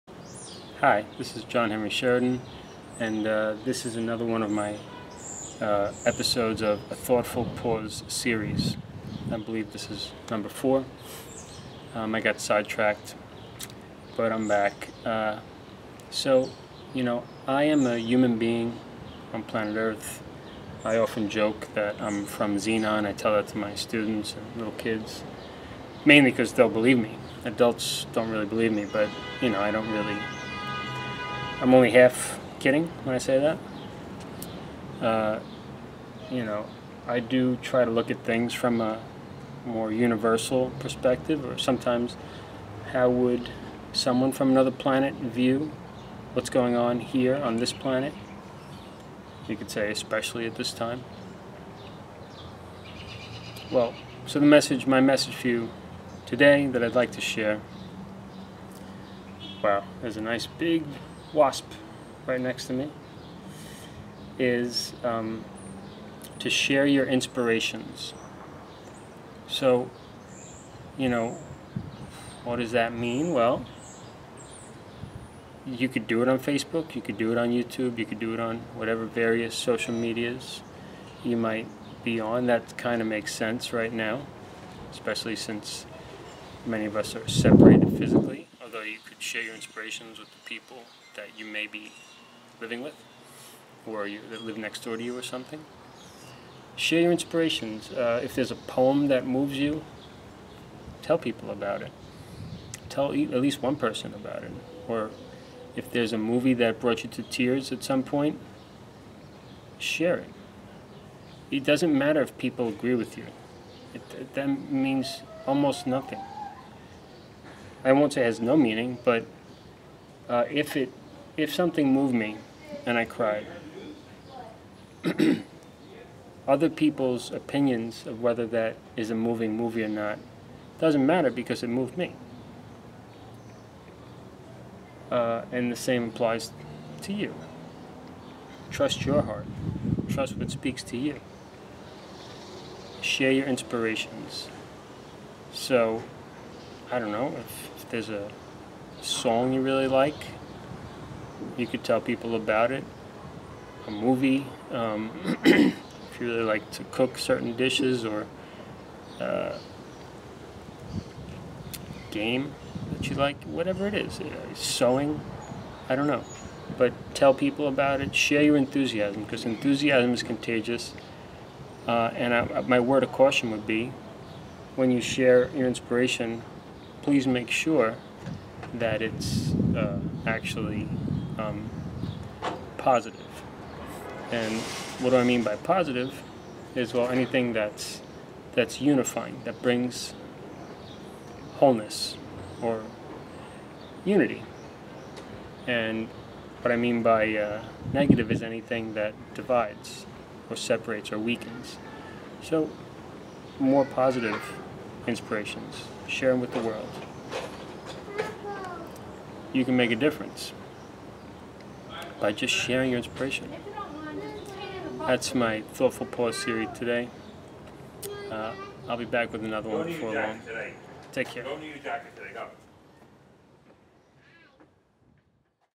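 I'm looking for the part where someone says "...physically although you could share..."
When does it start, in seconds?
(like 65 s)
87 s.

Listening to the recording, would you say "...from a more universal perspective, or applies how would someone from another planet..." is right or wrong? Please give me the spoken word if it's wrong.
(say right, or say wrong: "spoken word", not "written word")
wrong: "sometimes", not "applies".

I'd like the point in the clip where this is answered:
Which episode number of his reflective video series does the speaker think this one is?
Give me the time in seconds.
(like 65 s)
10 s.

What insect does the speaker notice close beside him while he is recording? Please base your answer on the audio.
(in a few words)
Wasp.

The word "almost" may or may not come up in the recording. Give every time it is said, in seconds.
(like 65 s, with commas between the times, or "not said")
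115 s.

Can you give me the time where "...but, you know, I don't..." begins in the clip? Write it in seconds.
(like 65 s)
28 s.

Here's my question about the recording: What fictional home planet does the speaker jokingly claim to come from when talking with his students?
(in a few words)
Xenon.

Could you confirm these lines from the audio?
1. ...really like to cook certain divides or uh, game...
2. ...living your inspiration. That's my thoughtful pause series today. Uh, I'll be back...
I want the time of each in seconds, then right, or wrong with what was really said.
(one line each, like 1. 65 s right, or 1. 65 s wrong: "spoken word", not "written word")
1. 156 s wrong: "dishes", not "divides"
2. 212 s wrong: "sharing", not "living".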